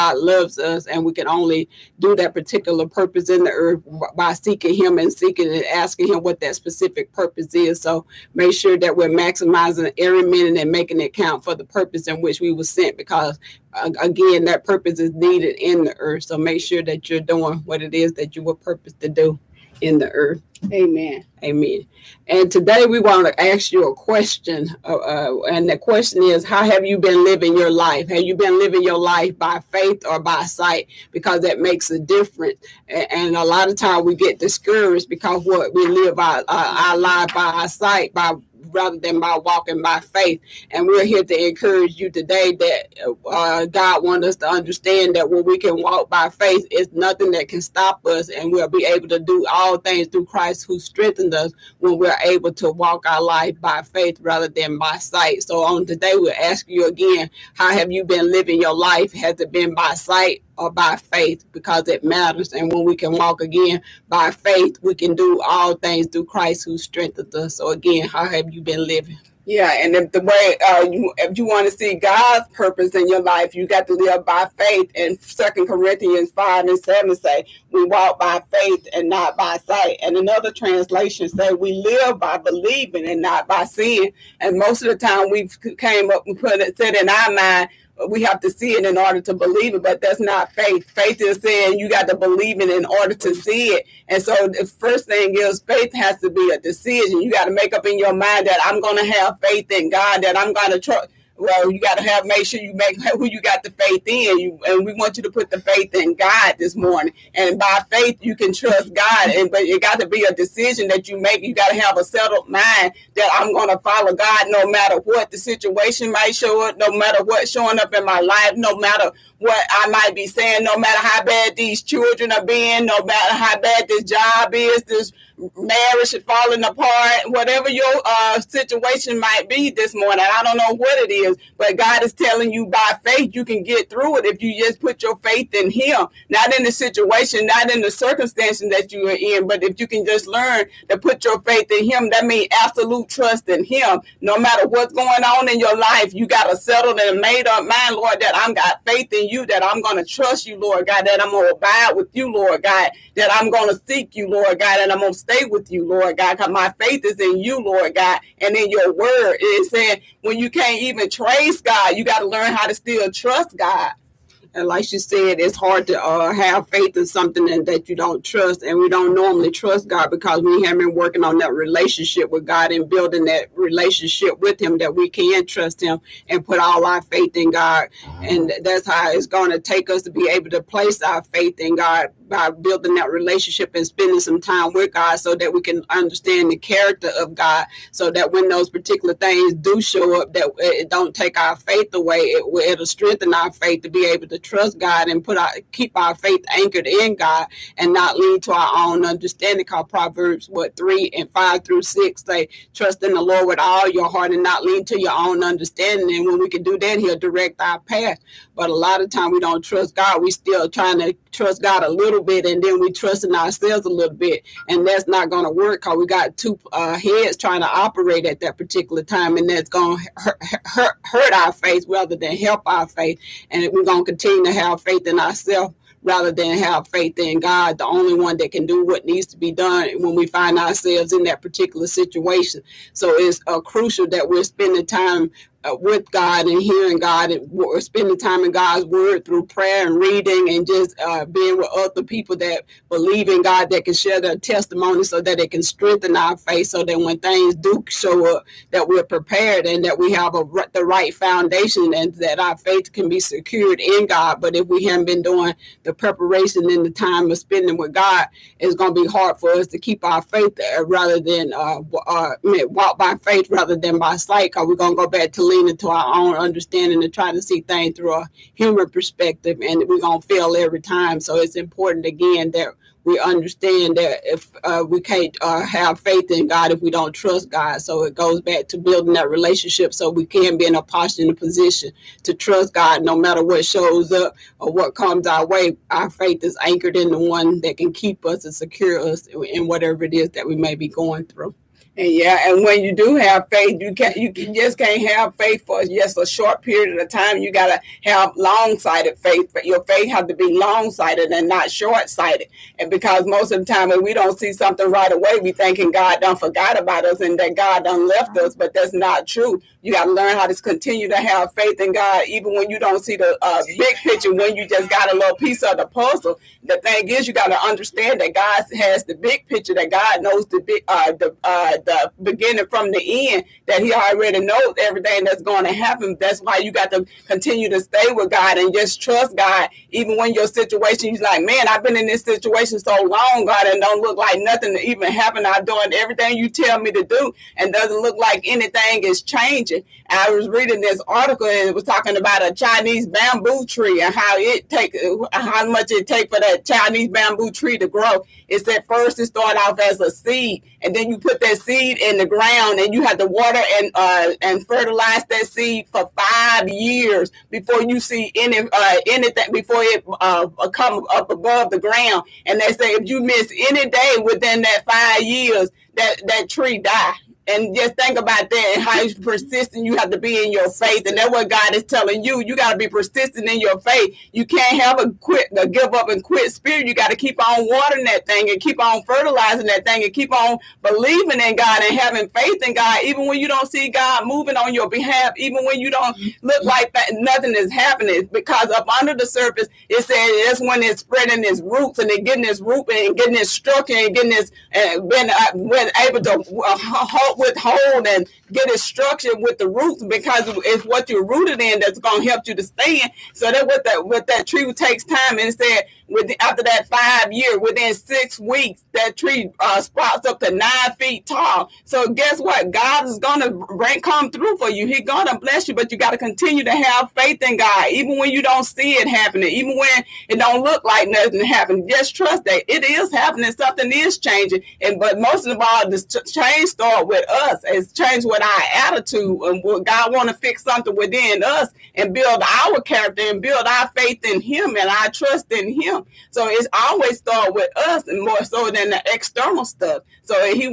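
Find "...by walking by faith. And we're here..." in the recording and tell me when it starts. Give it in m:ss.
0:39.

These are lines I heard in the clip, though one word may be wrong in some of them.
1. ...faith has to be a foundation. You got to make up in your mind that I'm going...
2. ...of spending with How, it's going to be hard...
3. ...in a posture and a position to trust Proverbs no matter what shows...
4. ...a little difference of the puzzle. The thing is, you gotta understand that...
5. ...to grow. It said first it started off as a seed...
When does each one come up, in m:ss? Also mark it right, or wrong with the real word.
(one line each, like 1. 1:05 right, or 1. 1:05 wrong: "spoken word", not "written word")
1. 1:35 wrong: "decision", not "foundation"
2. 4:17 wrong: "God", not "How"
3. 4:40 wrong: "God", not "Proverbs"
4. 5:15 wrong: "piece", not "difference"
5. 5:47 right.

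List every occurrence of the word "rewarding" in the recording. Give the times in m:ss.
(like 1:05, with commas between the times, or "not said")
not said.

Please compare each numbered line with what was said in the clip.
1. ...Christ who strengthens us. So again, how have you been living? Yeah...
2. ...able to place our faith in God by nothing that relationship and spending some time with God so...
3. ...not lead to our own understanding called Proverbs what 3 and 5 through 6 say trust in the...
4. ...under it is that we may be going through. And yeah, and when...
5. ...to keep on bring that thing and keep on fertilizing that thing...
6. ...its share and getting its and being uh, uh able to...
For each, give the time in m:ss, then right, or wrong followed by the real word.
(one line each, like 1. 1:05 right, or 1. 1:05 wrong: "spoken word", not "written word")
1. 1:06 right
2. 3:00 wrong: "building", not "nothing"
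3. 3:17 right
4. 4:49 wrong: "whatever", not "under"
5. 6:17 wrong: "watering", not "bring"
6. 6:33 wrong: "structure", not "share".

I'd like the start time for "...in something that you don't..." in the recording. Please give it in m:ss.
2:46.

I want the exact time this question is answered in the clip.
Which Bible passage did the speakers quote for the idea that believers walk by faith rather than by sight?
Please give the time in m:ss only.
1:15.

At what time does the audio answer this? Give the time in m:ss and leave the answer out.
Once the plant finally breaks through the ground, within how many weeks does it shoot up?
6:47.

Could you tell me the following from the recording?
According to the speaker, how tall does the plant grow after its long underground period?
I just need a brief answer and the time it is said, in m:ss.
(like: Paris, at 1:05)
9 feet, at 6:50.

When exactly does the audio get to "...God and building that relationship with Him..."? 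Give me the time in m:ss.
2:52.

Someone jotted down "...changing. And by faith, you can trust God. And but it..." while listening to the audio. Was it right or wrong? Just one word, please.
wrong.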